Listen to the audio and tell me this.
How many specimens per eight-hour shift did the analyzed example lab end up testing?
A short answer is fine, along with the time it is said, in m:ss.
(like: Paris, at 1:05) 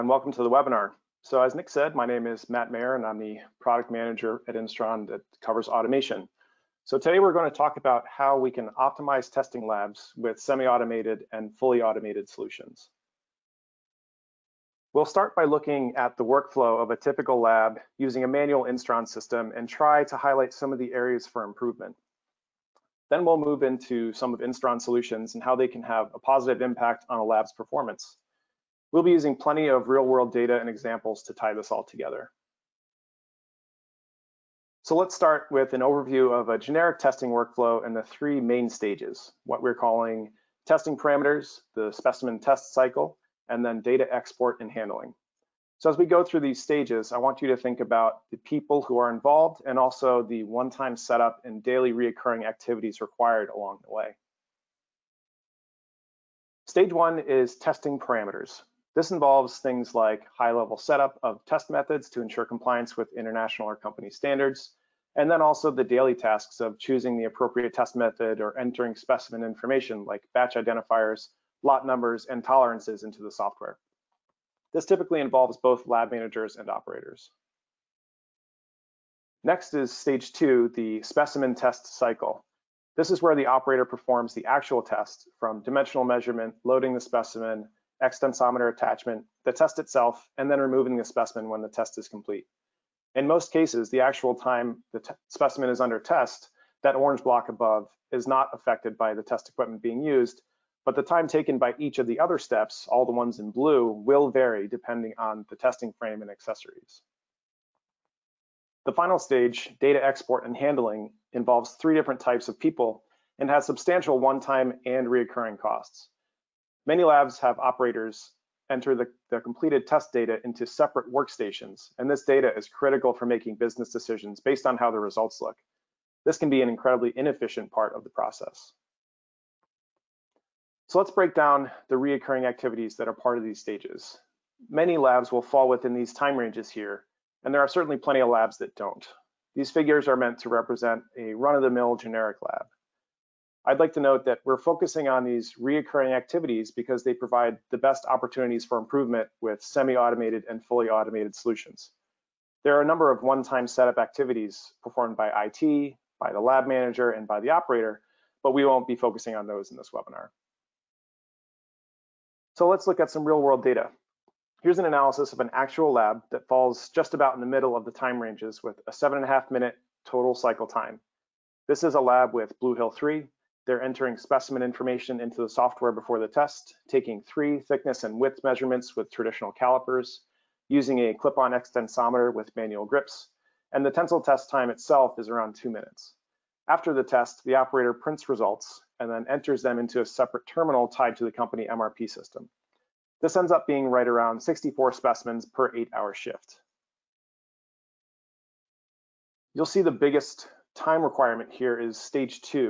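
64, at 3:14.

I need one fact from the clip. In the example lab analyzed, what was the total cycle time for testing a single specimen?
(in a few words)
7.5 minutes.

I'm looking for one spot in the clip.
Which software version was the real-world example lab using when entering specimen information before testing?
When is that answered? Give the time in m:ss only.
2:52.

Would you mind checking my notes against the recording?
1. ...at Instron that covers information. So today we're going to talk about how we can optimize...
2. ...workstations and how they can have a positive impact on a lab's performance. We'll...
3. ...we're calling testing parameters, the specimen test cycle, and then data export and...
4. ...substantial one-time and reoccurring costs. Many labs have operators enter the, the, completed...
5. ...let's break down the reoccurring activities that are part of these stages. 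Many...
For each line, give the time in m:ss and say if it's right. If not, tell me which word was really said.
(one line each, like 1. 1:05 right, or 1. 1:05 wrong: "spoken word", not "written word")
1. 0:04 wrong: "automation", not "information"
2. 0:24 wrong: "solutions", not "workstations"
3. 0:39 right
4. 1:53 right
5. 2:10 right.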